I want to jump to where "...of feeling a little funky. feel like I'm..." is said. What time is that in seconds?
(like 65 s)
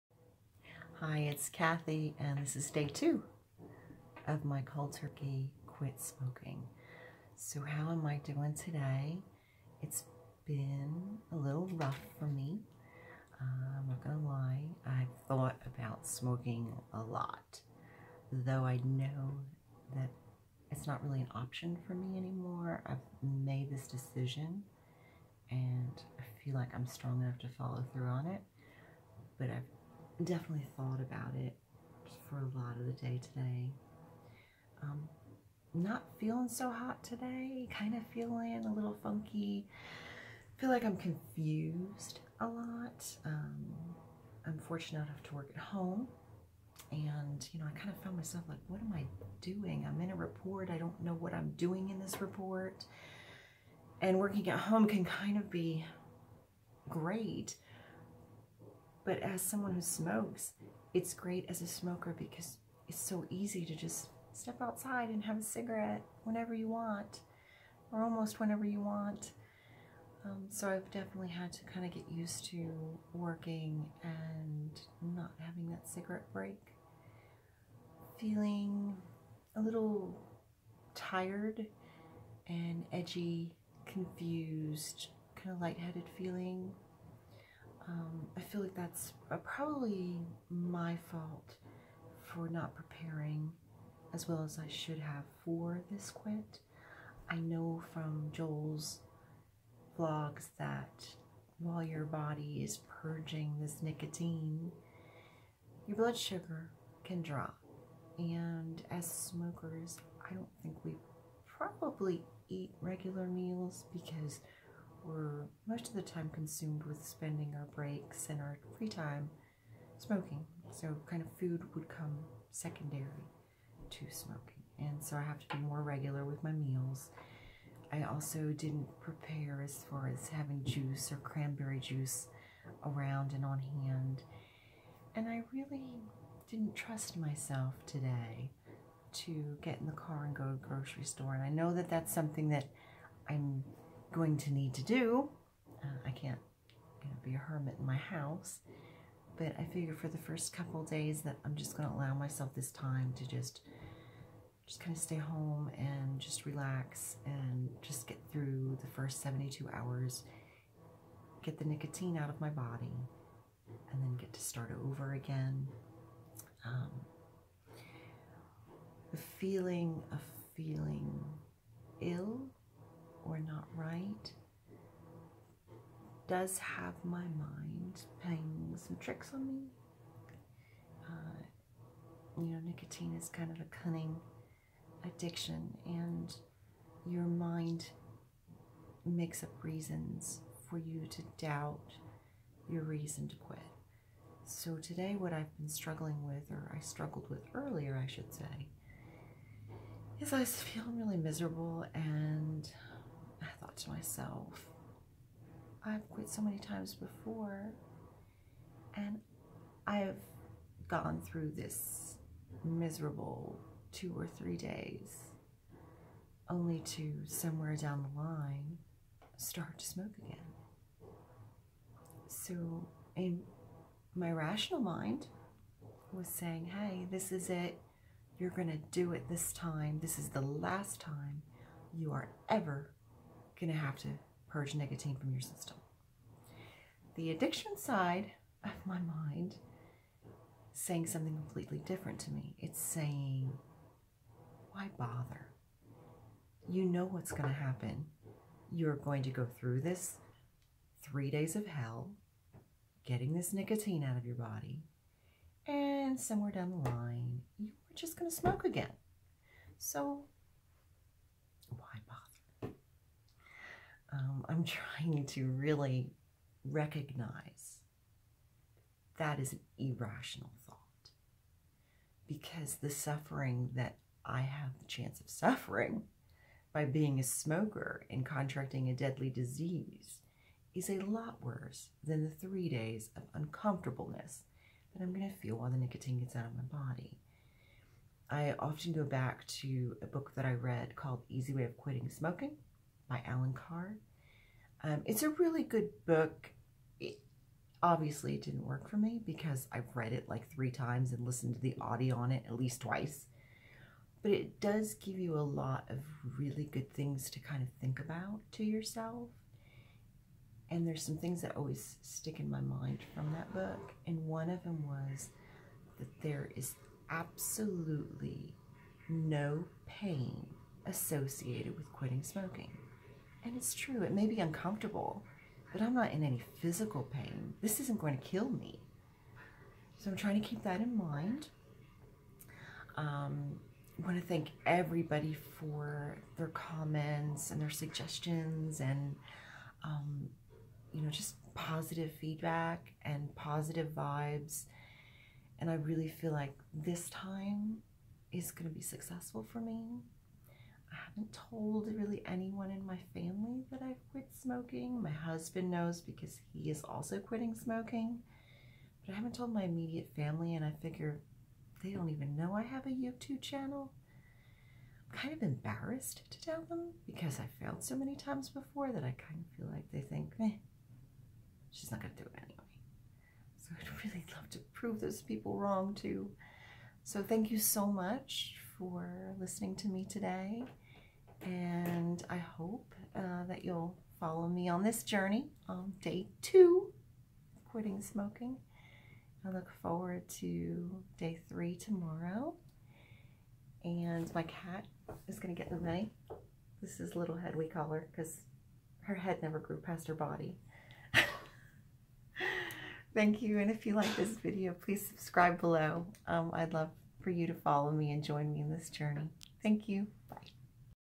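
37 s.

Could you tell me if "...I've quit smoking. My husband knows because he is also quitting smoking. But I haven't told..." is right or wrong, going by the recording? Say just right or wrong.
right.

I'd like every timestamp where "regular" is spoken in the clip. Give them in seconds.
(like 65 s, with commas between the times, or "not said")
112 s, 125 s.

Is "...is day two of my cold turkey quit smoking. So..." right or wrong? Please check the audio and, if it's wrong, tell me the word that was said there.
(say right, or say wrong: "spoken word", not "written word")
right.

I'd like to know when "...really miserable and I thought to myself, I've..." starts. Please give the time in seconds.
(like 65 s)
200 s.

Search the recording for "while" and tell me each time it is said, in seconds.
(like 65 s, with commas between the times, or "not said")
101 s, 285 s.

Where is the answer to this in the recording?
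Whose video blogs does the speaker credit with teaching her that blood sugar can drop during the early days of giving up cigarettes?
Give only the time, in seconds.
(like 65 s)
98 s.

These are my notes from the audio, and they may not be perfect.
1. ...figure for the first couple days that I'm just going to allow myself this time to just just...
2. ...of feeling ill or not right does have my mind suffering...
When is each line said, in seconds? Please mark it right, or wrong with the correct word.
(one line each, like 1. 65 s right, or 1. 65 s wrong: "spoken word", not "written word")
1. 149 s right
2. 170 s wrong: "playing", not "suffering".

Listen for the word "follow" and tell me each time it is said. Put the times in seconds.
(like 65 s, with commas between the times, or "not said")
27 s, 384 s, 407 s.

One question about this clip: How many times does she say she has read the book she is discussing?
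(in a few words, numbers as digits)
3 times.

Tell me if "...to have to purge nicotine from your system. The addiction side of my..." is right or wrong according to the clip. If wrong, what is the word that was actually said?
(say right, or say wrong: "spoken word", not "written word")
right.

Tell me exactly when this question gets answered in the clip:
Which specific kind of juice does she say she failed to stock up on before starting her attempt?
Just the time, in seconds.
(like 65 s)
131 s.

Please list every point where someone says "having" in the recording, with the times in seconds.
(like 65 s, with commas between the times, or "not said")
75 s, 130 s.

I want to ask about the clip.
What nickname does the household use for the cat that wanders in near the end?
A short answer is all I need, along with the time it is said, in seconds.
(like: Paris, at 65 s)
Little Head, at 397 s.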